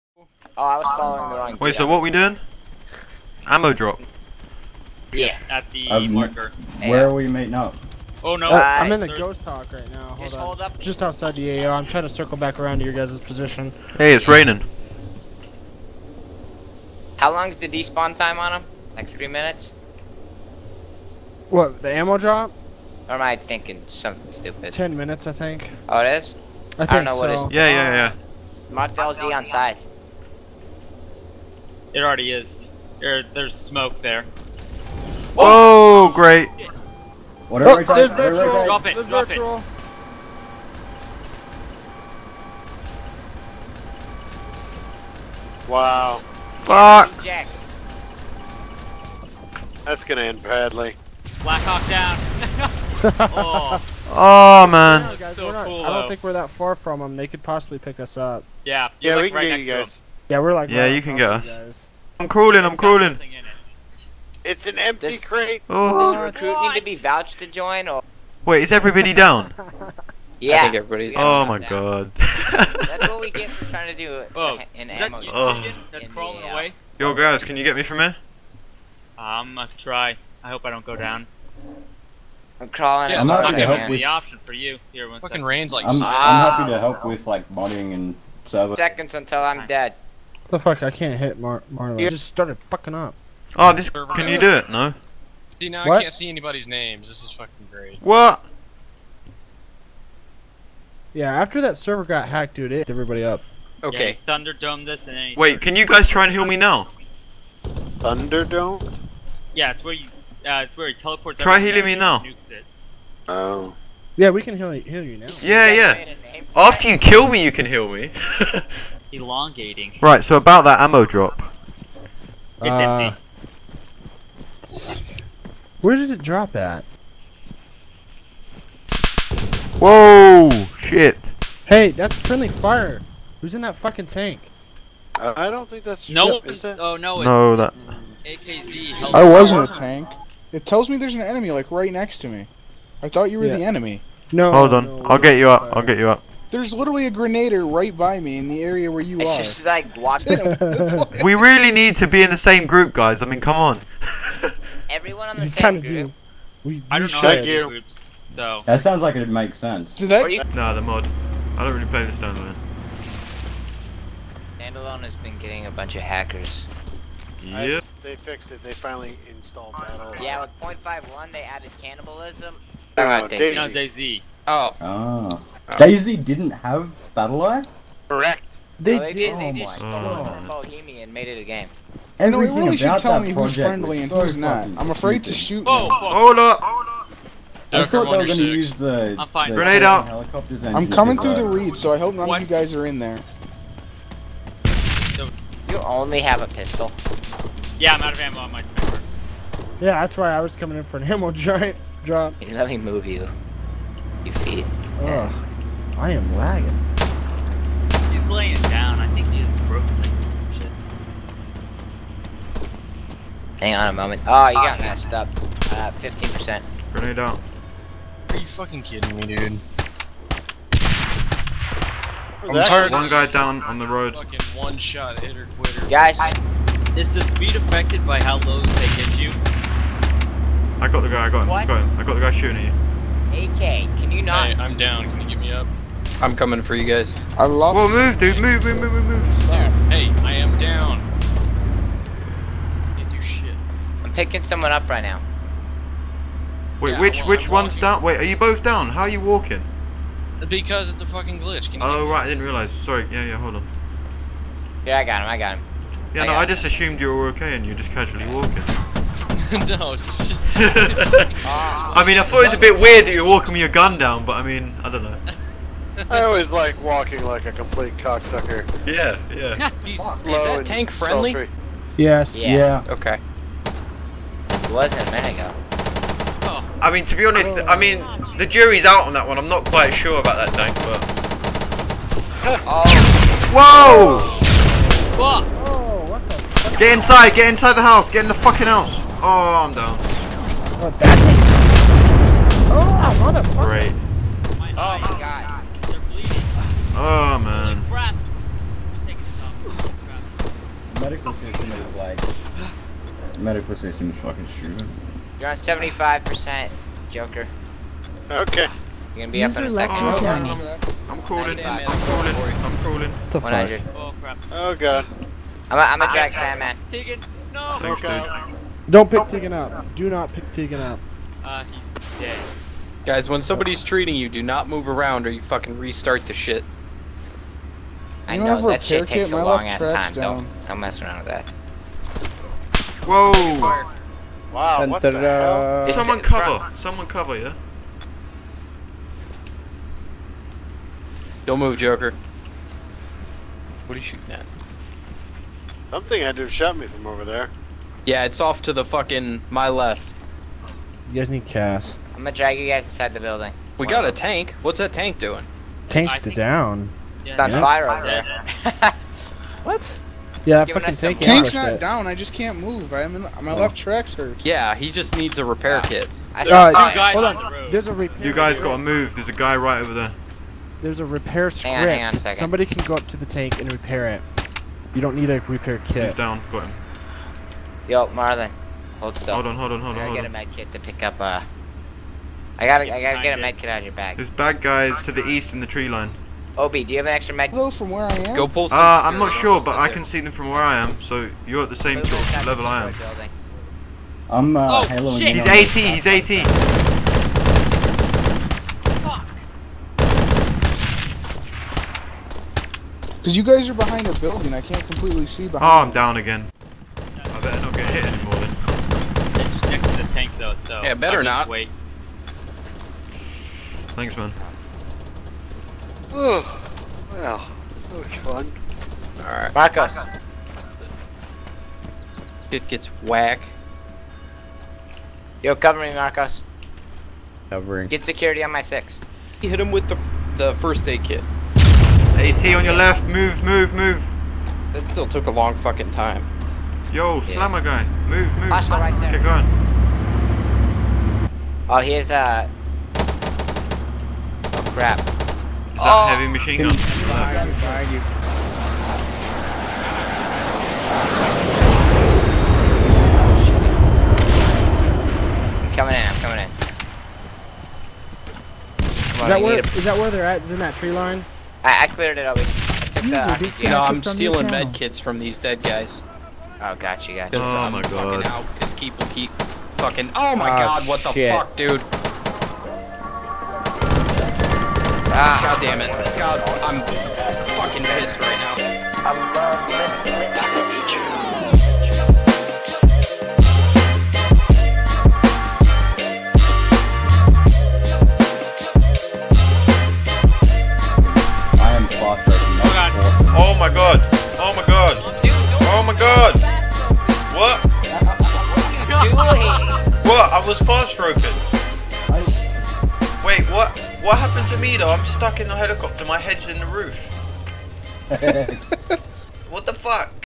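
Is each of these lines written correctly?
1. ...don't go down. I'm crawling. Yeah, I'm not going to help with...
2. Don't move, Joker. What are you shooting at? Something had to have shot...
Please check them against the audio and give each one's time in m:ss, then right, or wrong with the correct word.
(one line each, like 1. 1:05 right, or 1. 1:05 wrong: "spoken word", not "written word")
1. 1:20 right
2. 5:41 right.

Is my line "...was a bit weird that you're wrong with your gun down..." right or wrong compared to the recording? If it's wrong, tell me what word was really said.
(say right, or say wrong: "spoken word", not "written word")
wrong: "walking", not "wrong".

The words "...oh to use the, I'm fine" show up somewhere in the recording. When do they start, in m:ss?
3:08.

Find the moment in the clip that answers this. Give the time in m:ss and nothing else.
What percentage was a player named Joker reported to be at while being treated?
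5:05.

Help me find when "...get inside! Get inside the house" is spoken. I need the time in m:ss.
4:46.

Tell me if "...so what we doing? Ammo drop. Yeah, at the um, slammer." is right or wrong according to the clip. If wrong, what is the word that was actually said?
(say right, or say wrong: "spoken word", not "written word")
wrong: "marker", not "slammer".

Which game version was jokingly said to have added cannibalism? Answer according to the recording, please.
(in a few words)
0.51.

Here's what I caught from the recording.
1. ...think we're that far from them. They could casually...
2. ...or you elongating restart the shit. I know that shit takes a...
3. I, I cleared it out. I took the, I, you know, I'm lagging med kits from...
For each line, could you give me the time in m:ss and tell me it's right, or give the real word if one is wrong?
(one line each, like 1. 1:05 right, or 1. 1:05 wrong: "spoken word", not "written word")
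1. 0:56 wrong: "possibly", not "casually"
2. 5:25 wrong: "fucking", not "elongating"
3. 7:41 wrong: "stealing", not "lagging".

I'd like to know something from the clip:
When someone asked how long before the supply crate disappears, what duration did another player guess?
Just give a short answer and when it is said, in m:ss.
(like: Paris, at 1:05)
10 minutes, at 0:24.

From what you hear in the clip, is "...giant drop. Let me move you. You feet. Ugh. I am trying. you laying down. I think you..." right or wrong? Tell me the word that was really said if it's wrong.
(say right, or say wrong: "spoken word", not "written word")
wrong: "lagging", not "trying".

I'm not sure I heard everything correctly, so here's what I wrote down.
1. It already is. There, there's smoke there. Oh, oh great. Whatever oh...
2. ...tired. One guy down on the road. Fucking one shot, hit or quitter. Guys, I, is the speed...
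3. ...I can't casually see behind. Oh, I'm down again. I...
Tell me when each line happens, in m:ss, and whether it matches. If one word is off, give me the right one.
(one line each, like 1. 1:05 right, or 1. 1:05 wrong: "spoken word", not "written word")
1. 0:31 right
2. 3:42 right
3. 6:44 wrong: "completely", not "casually".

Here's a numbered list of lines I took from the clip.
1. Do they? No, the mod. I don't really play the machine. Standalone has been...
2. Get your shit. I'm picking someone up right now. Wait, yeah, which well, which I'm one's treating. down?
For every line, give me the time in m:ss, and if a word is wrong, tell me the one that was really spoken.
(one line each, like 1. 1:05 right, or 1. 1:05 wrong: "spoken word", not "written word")
1. 2:39 wrong: "standalone", not "machine"
2. 4:02 wrong: "walking", not "treating".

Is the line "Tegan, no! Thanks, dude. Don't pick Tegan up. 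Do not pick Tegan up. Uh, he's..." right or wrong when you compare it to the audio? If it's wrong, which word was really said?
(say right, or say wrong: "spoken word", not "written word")
right.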